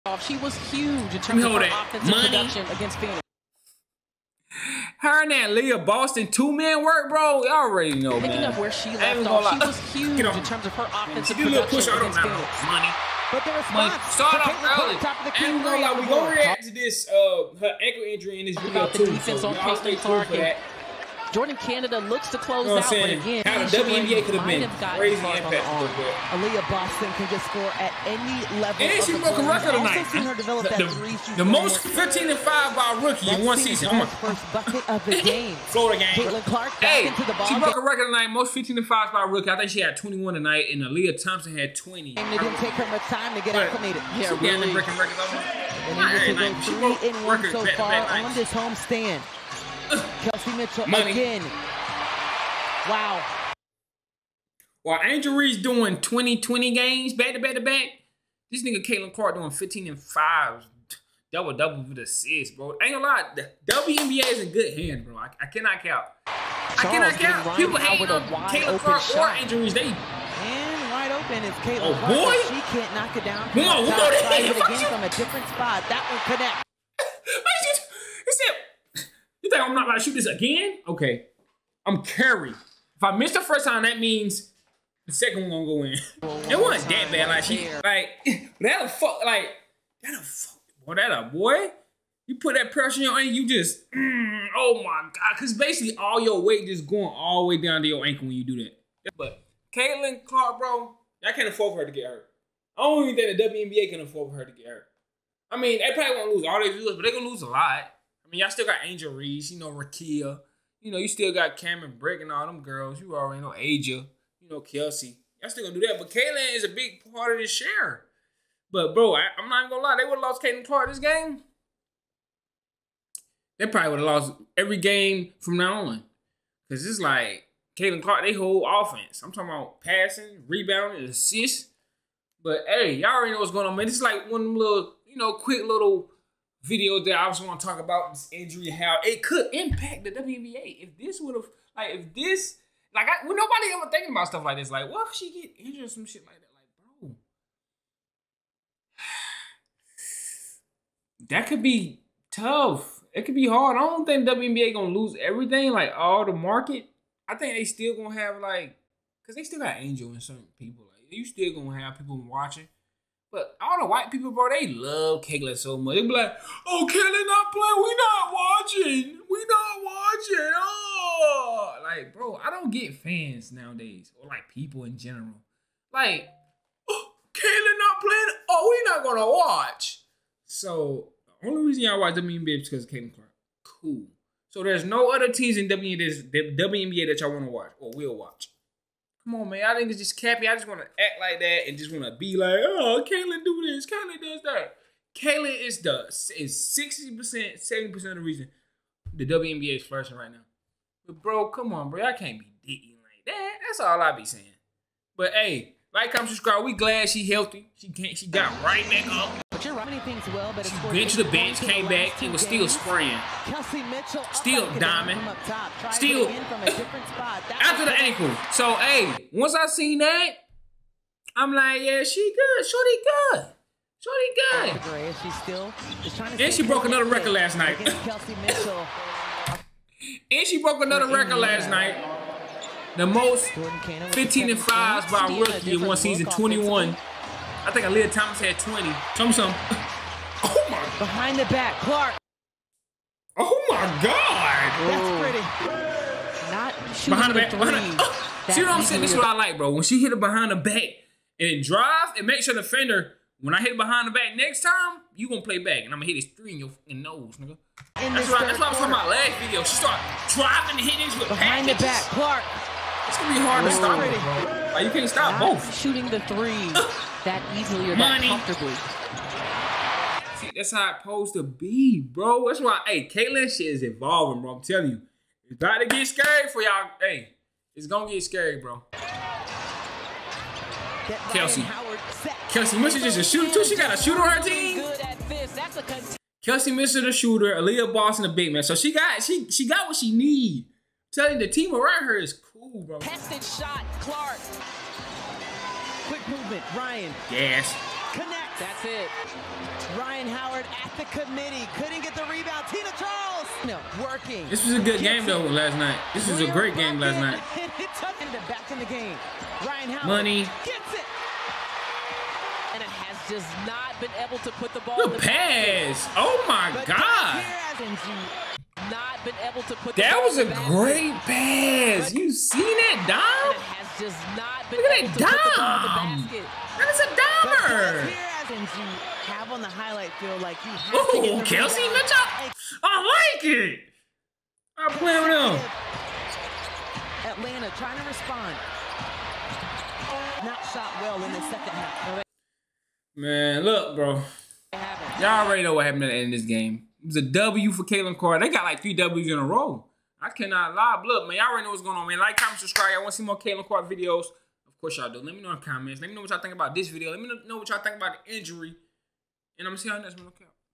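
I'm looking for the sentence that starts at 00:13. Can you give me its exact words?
But the response like, start off early.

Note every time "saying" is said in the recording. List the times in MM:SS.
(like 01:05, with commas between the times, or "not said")
03:24, 04:08.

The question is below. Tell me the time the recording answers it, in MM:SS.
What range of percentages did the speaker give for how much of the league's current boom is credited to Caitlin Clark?
03:16.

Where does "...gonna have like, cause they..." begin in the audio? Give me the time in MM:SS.
02:37.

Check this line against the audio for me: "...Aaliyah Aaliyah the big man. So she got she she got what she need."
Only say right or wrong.
wrong.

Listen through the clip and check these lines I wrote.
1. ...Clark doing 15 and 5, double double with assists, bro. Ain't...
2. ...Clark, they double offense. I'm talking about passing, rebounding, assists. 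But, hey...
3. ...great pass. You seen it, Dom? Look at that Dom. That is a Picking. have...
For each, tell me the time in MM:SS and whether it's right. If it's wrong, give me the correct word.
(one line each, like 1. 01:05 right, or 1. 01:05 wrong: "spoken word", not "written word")
1. 00:59 right
2. 02:08 wrong: "whole", not "double"
3. 05:20 wrong: "Dommer", not "Picking".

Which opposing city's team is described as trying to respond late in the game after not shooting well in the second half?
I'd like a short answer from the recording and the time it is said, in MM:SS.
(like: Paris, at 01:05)
Atlanta, at 05:37.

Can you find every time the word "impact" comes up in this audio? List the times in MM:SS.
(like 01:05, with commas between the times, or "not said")
00:25, 02:19.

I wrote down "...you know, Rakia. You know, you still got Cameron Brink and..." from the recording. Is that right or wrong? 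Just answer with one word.
right.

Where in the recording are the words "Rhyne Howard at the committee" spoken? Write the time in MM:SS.
04:59.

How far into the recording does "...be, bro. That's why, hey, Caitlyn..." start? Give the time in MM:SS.
04:31.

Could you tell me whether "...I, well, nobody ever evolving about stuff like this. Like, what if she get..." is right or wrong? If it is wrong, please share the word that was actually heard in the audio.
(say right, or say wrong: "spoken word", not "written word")
wrong: "thinking", not "evolving".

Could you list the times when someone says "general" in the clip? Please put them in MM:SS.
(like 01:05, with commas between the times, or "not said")
02:54.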